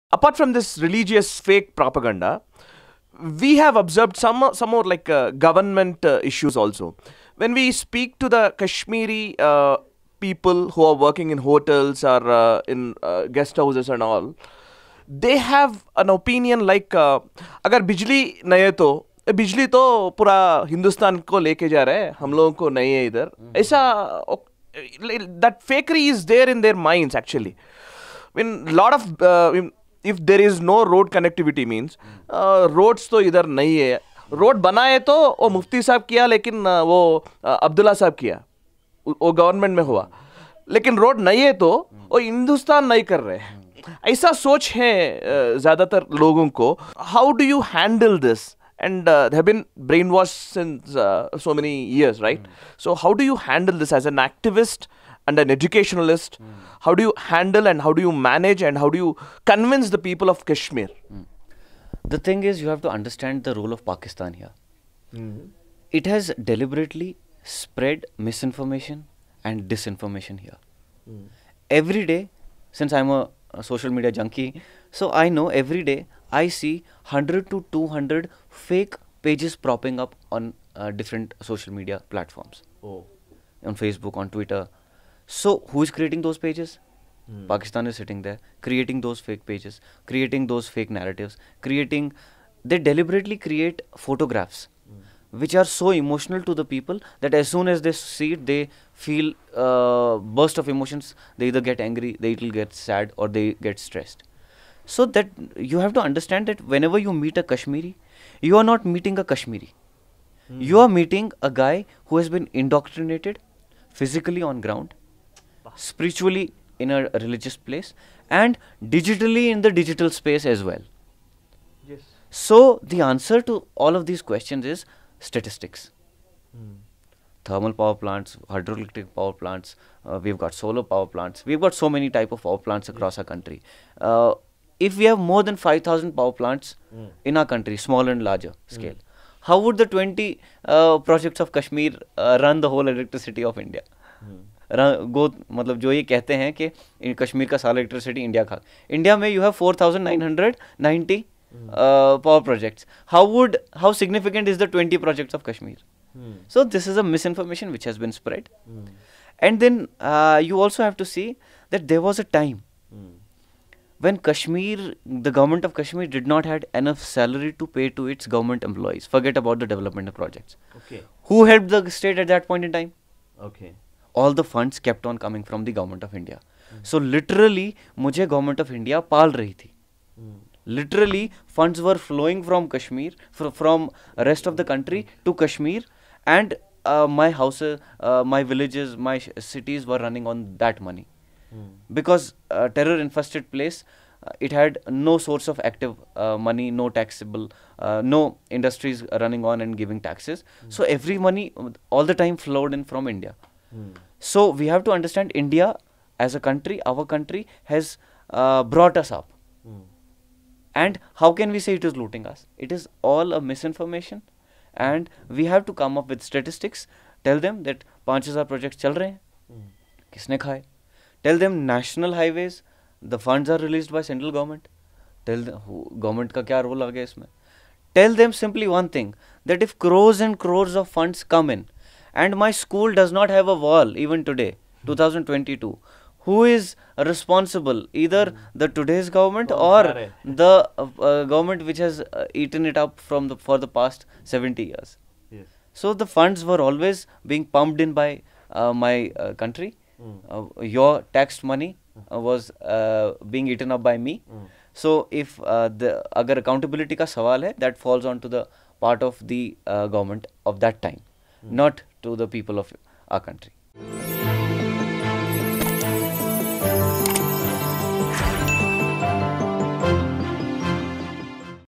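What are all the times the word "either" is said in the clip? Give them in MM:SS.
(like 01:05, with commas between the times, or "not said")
01:41, 03:57.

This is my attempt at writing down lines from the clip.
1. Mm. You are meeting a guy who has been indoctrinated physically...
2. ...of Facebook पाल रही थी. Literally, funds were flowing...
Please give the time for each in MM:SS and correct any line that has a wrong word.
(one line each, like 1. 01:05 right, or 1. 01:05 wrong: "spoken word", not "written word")
1. 01:50 right
2. 02:58 wrong: "India", not "Facebook".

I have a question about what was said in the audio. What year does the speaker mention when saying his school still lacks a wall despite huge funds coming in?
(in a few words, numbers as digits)
2022.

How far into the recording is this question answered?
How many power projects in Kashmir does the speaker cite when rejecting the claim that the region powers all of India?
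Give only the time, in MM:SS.
02:19.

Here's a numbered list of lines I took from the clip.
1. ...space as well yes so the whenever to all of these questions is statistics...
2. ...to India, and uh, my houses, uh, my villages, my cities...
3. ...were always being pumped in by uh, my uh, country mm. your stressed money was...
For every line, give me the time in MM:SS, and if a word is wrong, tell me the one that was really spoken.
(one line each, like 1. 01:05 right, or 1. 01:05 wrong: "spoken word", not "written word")
1. 02:00 wrong: "answer", not "whenever"
2. 03:05 wrong: "Kashmir", not "India"
3. 04:06 wrong: "taxed", not "stressed".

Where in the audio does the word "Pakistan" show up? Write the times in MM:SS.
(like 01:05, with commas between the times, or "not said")
01:03, 01:27.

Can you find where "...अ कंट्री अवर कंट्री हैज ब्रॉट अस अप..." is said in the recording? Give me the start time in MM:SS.
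03:26.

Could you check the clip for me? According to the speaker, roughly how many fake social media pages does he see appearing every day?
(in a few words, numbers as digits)
100 to 200.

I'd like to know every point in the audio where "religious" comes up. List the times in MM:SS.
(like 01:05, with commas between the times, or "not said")
00:00, 01:57.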